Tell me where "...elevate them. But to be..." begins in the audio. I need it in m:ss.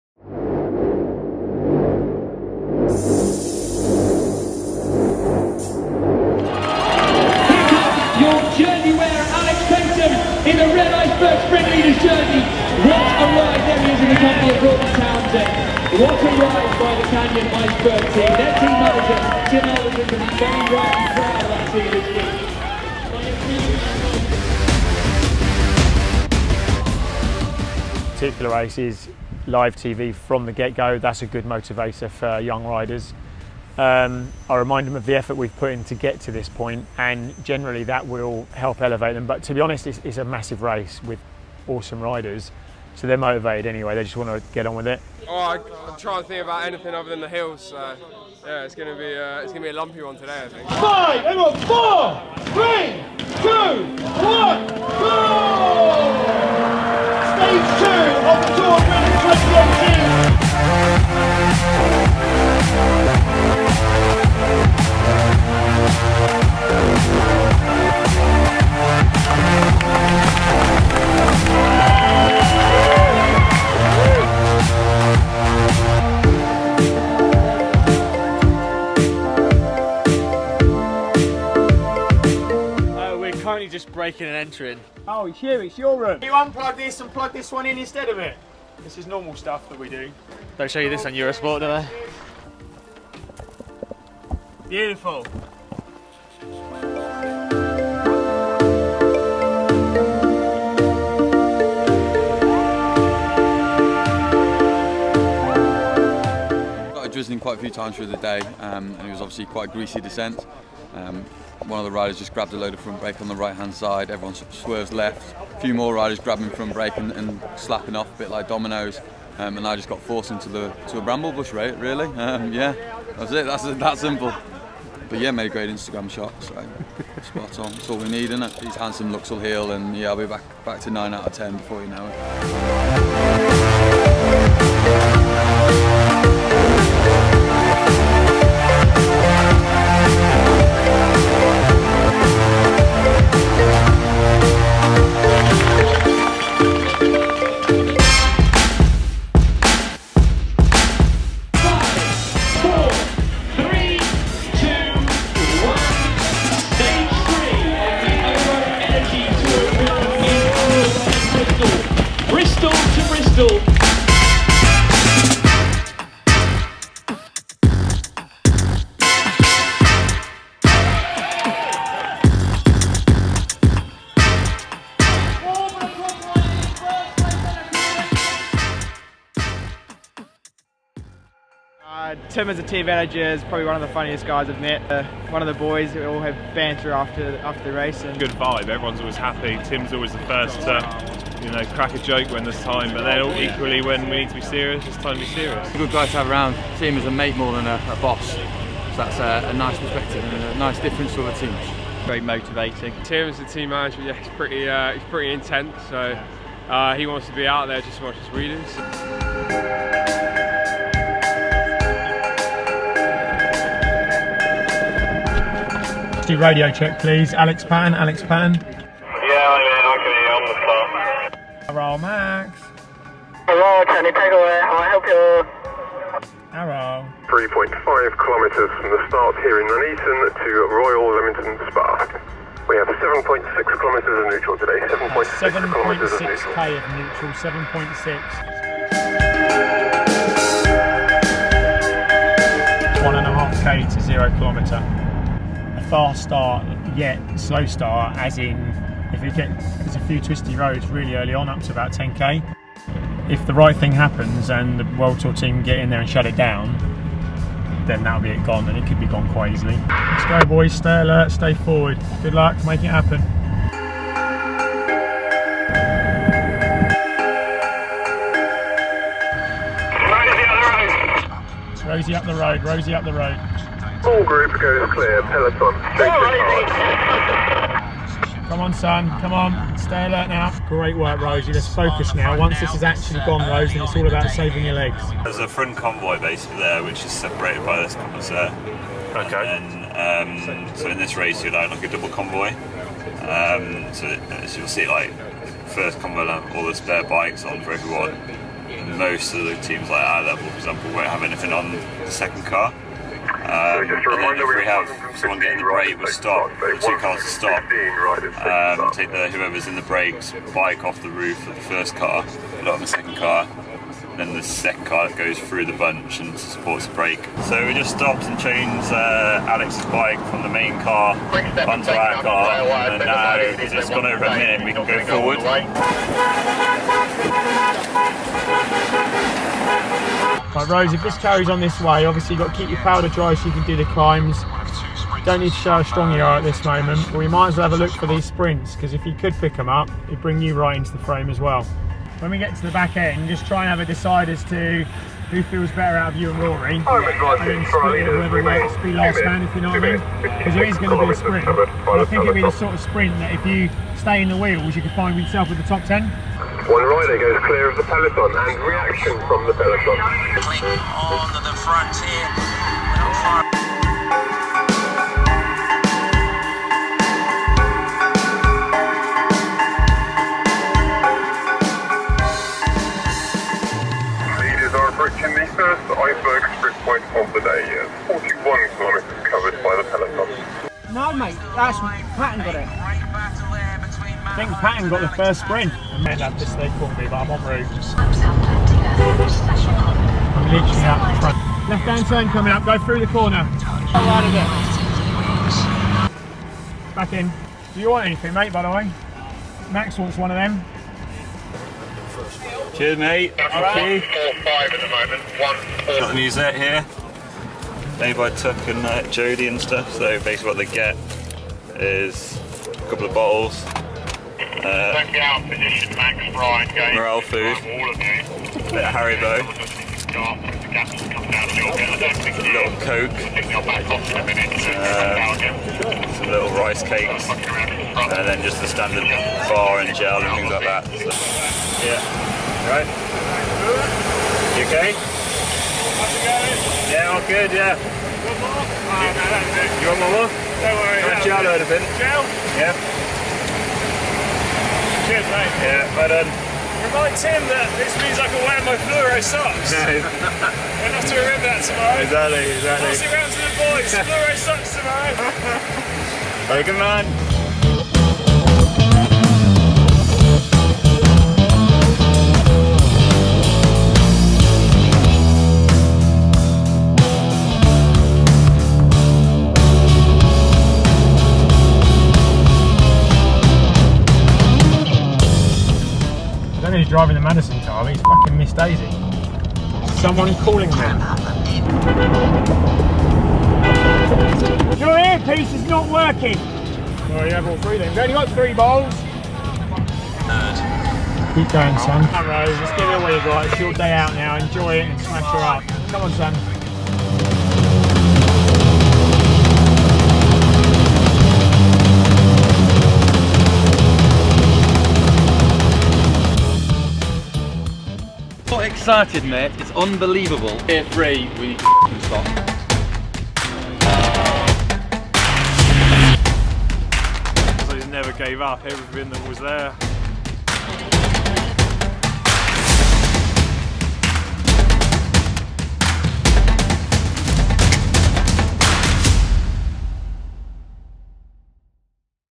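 0:38.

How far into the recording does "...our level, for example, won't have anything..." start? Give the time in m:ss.
5:00.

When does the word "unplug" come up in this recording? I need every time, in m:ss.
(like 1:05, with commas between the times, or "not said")
1:26.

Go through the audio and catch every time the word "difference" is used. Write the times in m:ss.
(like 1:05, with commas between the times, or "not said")
3:20.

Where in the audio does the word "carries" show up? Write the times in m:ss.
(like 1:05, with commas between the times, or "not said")
5:31.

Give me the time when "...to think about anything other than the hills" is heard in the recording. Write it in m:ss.
0:46.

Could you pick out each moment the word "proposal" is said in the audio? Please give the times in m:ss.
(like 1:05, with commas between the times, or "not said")
not said.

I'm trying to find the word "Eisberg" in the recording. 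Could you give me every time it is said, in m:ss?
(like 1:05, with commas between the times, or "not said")
0:17, 6:15.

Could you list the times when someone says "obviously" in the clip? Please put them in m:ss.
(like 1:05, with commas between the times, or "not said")
1:49, 5:32.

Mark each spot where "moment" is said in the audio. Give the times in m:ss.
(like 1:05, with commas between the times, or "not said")
5:36, 6:44.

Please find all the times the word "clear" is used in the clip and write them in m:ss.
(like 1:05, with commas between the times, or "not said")
4:34, 5:57.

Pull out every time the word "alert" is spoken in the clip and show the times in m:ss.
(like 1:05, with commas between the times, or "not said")
4:21, 4:40.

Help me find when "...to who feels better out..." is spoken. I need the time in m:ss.
5:44.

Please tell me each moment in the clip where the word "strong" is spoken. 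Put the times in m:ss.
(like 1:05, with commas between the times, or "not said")
5:35.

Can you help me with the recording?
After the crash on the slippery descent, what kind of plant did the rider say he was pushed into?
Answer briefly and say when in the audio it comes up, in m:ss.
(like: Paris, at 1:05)
bramble bush, at 2:01.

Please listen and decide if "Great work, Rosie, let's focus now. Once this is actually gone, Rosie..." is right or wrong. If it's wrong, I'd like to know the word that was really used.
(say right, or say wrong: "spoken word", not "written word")
right.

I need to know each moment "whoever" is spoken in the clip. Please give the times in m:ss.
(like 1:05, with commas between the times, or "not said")
5:09, 5:48.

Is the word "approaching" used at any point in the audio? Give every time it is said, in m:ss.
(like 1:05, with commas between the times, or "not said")
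6:14.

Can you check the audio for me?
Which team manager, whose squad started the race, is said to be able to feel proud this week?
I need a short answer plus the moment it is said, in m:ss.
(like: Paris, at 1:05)
Tim Elverson, at 0:19.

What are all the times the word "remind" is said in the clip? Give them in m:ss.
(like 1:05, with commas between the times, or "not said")
0:34, 7:26.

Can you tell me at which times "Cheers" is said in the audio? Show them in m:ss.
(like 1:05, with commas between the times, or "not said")
6:42.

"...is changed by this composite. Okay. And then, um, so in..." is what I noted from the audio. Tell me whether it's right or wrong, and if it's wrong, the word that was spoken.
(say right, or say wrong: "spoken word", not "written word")
wrong: "separated", not "changed".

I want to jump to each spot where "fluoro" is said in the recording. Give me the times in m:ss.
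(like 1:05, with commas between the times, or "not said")
7:28, 7:33.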